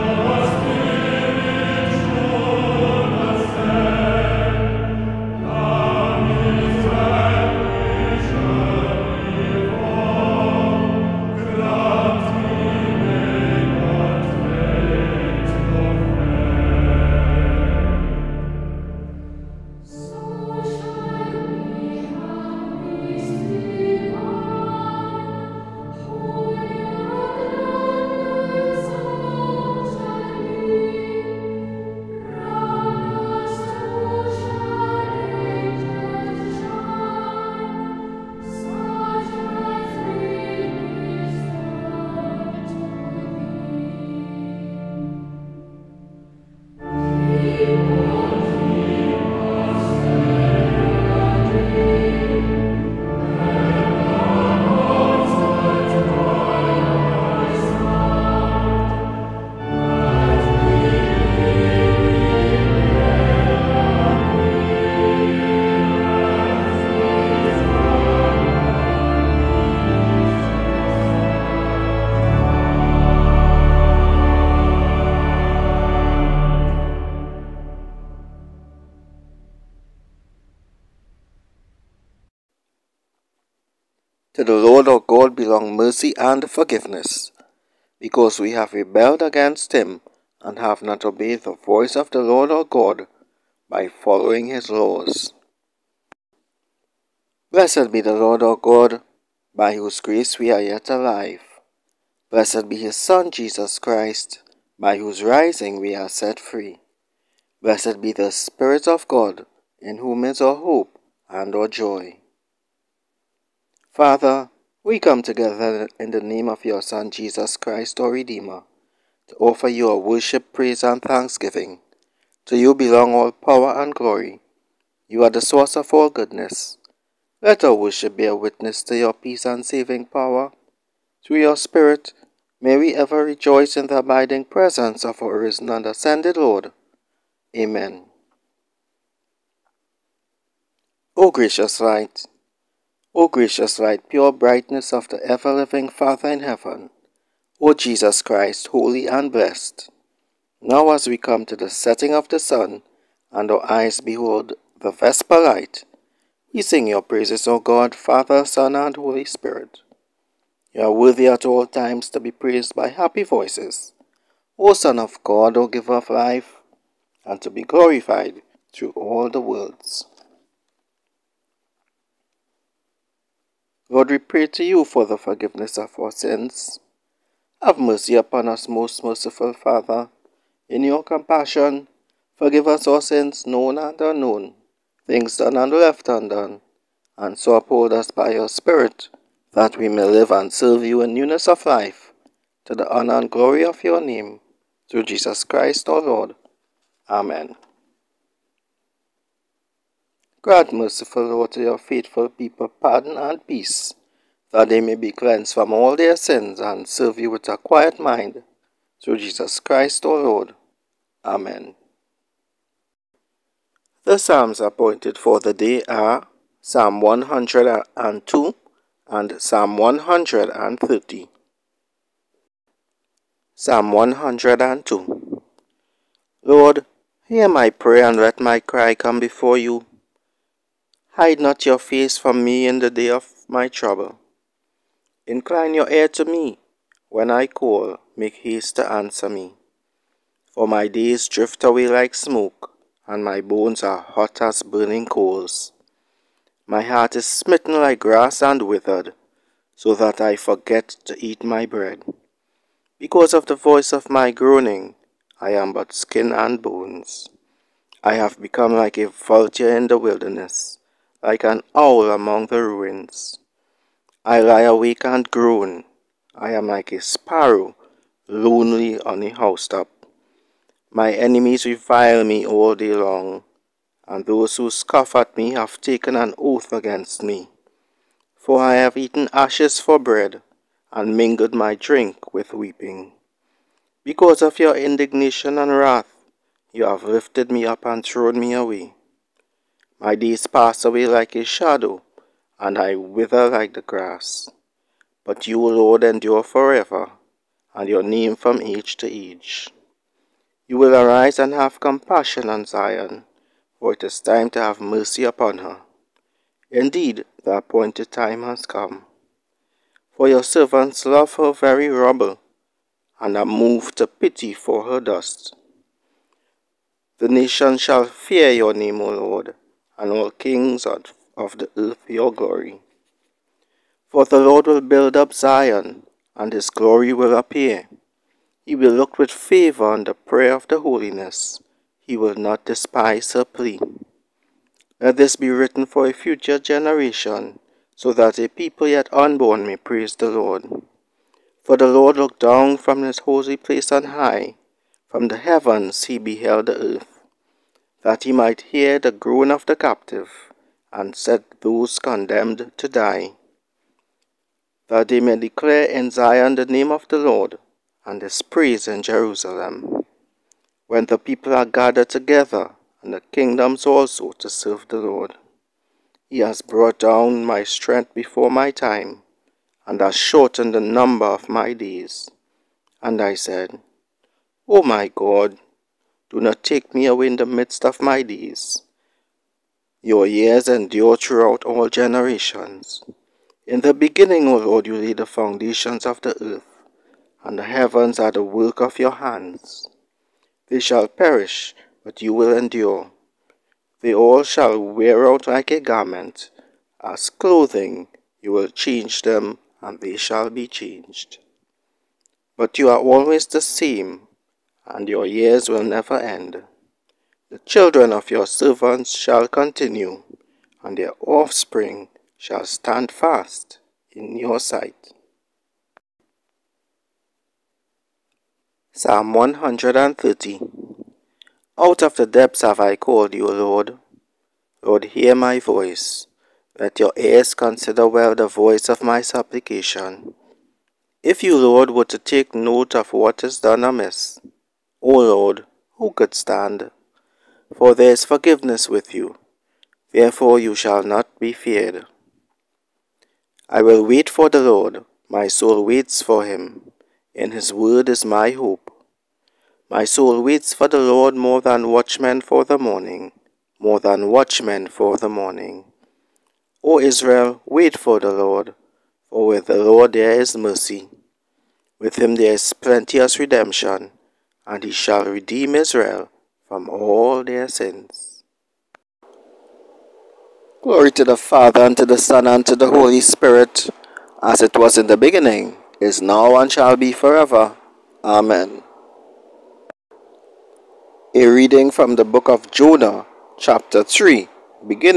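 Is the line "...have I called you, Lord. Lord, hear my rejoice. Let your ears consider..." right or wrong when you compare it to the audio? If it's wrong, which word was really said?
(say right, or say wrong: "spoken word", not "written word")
wrong: "voice", not "rejoice".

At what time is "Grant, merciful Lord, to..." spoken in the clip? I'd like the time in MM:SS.
03:20.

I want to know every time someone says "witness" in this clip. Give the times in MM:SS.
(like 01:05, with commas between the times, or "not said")
02:08.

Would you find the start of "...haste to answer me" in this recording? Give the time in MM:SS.
03:58.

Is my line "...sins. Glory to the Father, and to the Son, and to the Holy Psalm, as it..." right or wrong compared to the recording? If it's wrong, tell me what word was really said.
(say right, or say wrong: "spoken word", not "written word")
wrong: "Spirit", not "Psalm".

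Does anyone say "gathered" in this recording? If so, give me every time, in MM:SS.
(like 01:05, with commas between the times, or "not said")
06:01.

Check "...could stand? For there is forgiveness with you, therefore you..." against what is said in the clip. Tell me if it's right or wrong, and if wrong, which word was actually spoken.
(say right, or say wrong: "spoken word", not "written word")
right.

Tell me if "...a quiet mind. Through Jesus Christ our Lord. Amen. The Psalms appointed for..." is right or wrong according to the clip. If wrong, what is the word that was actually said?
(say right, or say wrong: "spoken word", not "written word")
right.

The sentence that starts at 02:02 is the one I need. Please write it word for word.
To you belong all power and glory.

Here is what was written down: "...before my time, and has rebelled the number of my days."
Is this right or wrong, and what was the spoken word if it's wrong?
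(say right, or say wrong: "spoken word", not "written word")
wrong: "shortened", not "rebelled".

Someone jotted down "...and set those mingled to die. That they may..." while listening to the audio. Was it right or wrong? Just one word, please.
wrong.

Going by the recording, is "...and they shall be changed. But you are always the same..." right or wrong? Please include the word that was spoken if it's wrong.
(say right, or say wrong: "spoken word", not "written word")
right.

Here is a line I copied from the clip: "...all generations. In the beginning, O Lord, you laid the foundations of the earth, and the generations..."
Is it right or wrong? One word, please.
wrong.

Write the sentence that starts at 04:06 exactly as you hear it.
My heart is smitten like grass and withered, so that I forget to eat my bread.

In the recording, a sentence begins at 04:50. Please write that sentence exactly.
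My days pass away like a shadow, and I wither like the grass.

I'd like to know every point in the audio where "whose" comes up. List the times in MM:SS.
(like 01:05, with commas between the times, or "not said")
01:39, 01:44.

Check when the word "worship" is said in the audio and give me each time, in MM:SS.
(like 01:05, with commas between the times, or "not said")
01:59, 02:07.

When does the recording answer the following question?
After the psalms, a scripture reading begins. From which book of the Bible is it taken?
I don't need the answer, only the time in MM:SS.
08:02.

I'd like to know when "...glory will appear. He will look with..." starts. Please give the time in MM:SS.
05:26.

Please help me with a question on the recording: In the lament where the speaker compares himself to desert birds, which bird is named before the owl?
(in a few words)
vulture.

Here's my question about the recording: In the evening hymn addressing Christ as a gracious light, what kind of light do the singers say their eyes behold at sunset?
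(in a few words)
vesper light.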